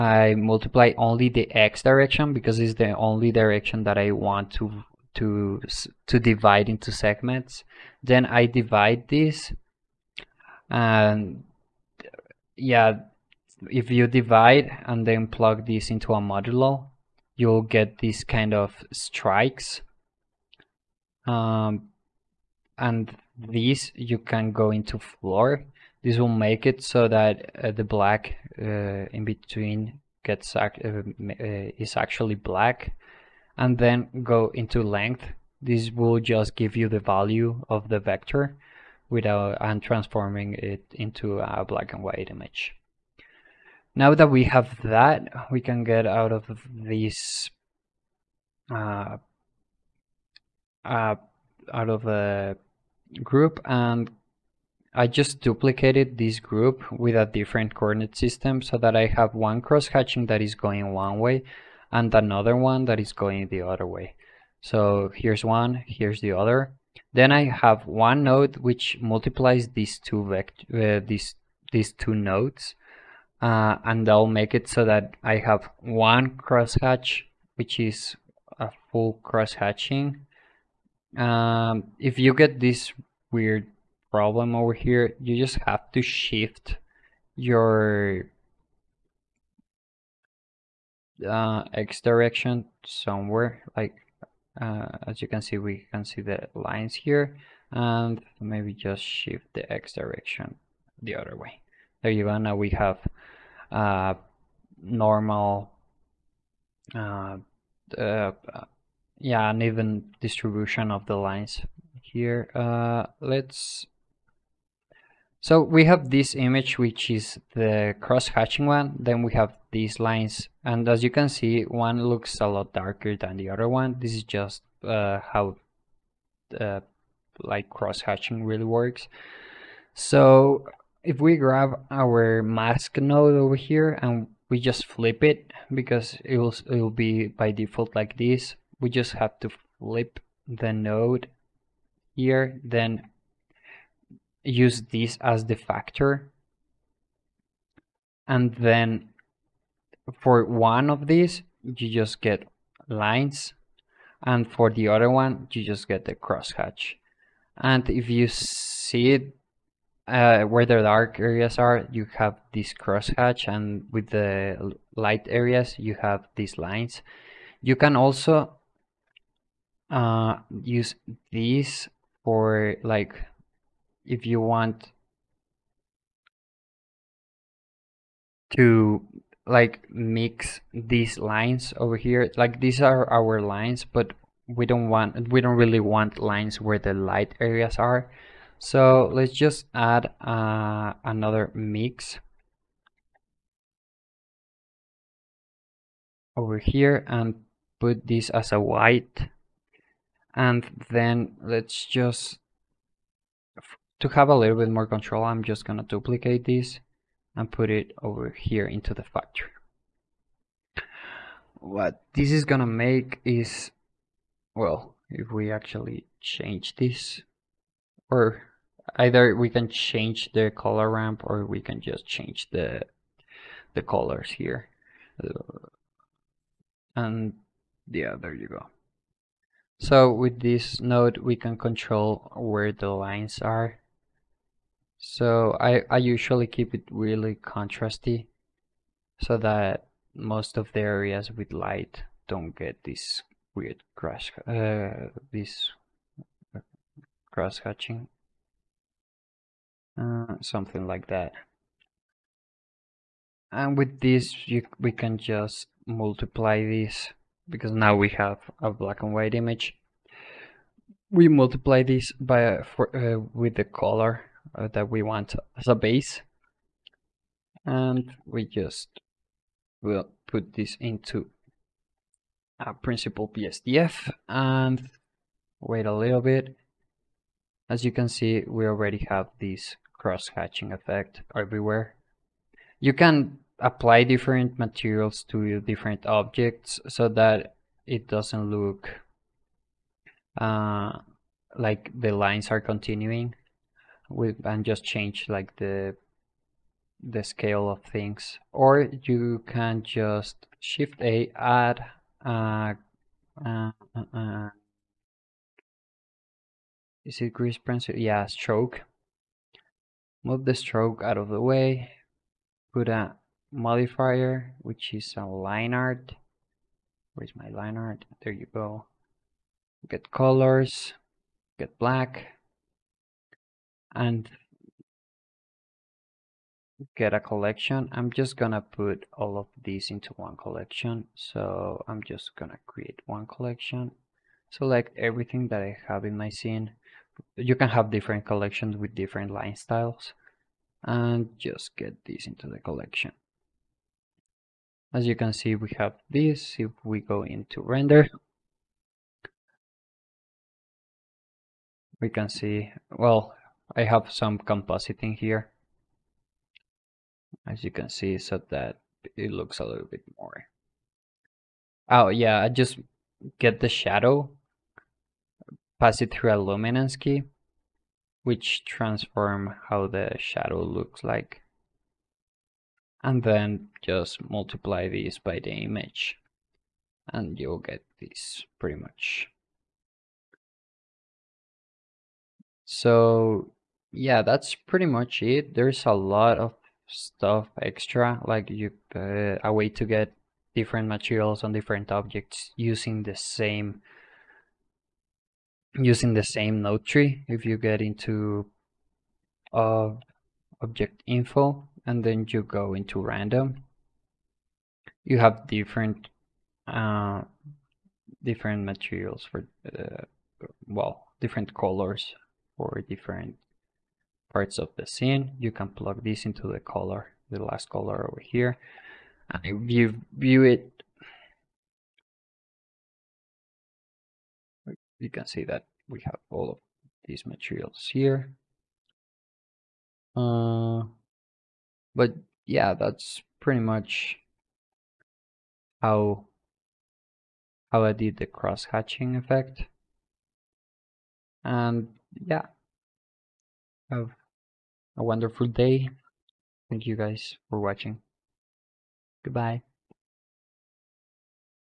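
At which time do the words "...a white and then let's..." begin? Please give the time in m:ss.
3:18.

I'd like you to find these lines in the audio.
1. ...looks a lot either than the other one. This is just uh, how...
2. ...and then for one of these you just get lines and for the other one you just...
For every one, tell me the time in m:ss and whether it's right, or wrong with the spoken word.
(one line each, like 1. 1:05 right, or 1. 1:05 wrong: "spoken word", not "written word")
1. 2:02 wrong: "darker", not "either"
2. 2:28 right.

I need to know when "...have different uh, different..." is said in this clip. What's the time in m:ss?
6:45.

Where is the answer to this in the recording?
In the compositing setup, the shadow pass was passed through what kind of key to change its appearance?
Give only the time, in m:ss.
6:06.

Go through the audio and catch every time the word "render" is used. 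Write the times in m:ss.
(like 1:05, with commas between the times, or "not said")
5:47.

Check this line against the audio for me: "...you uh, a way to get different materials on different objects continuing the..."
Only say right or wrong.
wrong.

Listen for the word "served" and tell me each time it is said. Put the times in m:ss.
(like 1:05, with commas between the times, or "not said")
not said.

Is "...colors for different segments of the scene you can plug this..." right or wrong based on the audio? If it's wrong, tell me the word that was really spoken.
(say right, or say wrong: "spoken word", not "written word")
wrong: "parts", not "segments".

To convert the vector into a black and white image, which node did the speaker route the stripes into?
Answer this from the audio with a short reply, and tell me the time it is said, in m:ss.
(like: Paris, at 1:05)
length, at 0:34.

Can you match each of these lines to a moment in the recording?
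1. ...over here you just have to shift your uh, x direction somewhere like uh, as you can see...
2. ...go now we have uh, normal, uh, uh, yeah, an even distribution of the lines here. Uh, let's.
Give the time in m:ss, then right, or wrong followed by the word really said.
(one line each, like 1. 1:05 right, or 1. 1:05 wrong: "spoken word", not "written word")
1. 1:24 right
2. 1:42 right.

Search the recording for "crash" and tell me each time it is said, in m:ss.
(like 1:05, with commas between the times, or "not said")
4:03.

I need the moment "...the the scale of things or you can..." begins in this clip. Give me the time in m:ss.
4:55.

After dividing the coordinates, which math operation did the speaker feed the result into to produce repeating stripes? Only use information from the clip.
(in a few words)
modulo.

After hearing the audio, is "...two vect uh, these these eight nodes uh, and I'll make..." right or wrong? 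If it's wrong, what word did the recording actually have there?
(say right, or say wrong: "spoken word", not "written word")
wrong: "two", not "eight".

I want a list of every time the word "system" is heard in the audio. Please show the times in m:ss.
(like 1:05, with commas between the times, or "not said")
0:58.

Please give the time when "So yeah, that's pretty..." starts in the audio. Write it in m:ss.
6:22.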